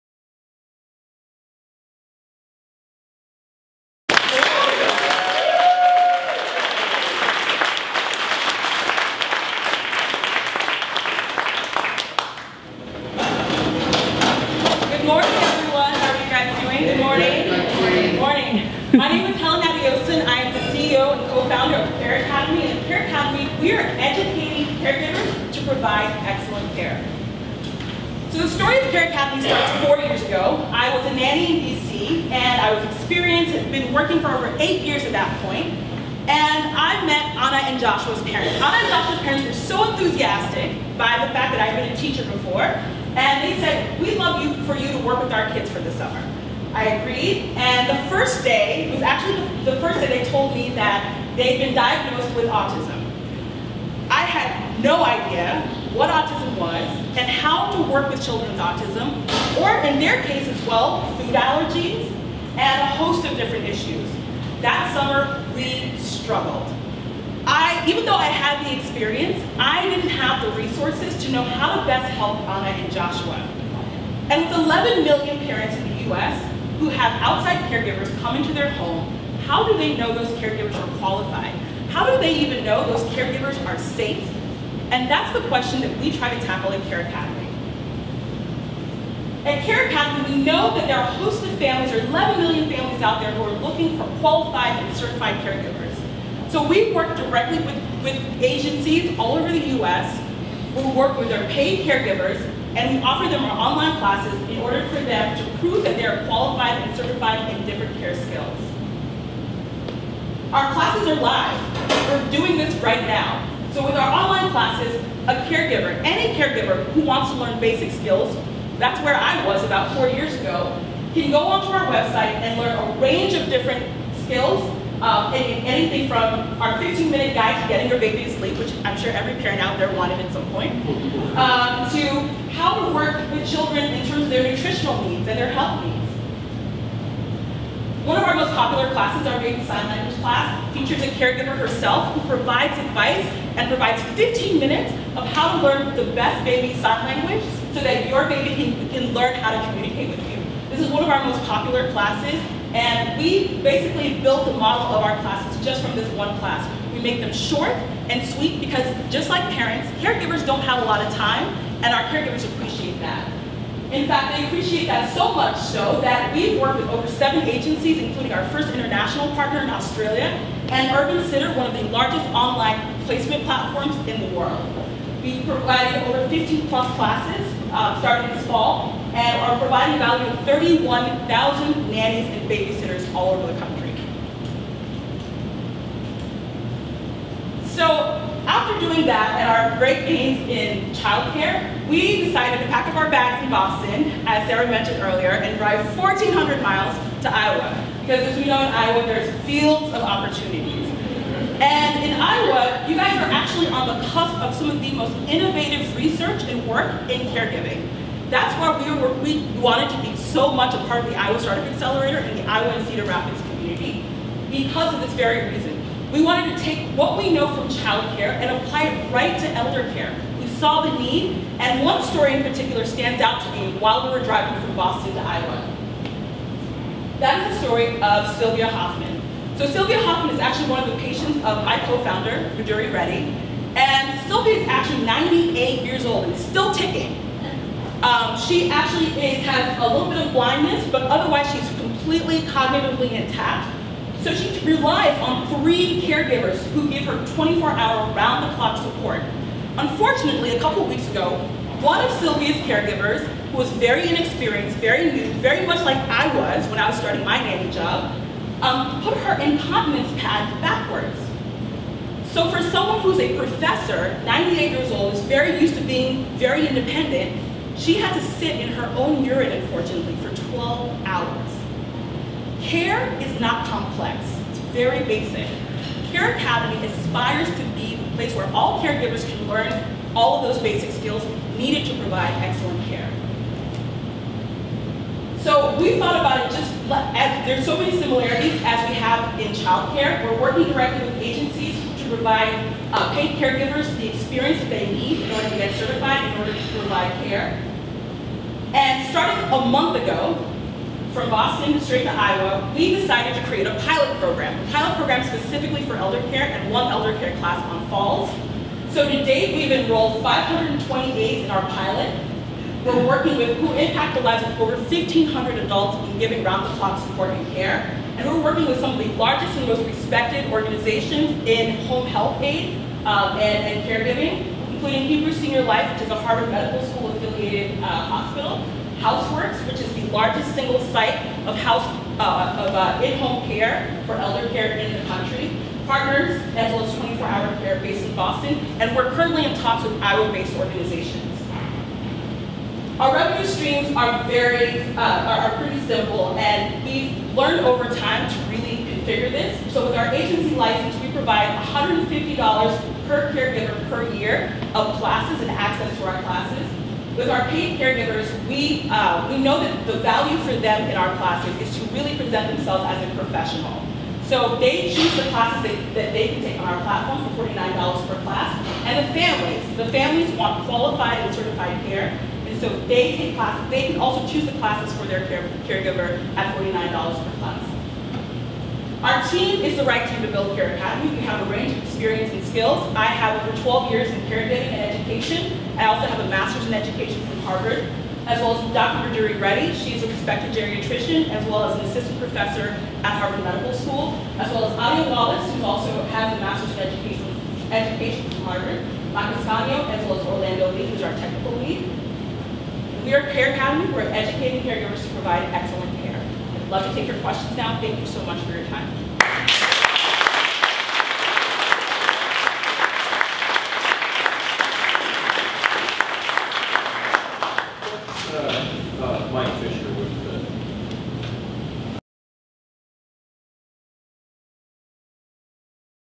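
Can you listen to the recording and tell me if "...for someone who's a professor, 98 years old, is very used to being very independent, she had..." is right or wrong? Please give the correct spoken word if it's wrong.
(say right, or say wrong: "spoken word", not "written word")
right.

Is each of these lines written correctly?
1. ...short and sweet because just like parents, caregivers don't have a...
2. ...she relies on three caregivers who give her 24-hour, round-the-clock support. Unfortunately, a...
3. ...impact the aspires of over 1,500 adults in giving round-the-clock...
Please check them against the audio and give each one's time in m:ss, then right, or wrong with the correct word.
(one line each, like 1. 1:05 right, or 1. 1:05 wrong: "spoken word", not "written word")
1. 2:37 right
2. 4:04 right
3. 5:13 wrong: "lives", not "aspires".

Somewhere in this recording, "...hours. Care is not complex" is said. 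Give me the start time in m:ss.
4:31.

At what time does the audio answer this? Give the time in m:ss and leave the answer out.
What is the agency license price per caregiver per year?
5:51.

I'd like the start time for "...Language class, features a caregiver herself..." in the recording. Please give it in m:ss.
2:19.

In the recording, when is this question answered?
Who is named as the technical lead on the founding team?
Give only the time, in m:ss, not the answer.
6:40.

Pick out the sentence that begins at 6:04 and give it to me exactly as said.
So they choose the classes that, that they can take on our platform for $49 per class.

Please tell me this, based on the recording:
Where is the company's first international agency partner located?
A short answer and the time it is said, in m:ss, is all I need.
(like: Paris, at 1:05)
Australia, at 2:49.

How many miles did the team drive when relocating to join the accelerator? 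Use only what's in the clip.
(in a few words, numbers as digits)
1,400.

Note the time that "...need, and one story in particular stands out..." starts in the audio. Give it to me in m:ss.
3:40.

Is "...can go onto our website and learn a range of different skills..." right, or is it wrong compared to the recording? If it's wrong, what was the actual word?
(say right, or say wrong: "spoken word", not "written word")
right.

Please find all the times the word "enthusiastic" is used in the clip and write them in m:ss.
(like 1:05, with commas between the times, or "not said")
0:39.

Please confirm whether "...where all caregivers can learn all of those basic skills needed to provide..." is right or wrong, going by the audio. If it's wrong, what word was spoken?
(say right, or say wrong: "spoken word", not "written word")
right.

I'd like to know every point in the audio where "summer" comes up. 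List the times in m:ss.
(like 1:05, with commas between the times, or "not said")
0:45, 1:04.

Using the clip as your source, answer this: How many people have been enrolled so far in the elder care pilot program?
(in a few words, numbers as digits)
528.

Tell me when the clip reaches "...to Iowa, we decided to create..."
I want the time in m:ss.
5:02.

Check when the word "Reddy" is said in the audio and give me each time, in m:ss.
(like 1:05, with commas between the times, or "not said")
3:52, 6:29.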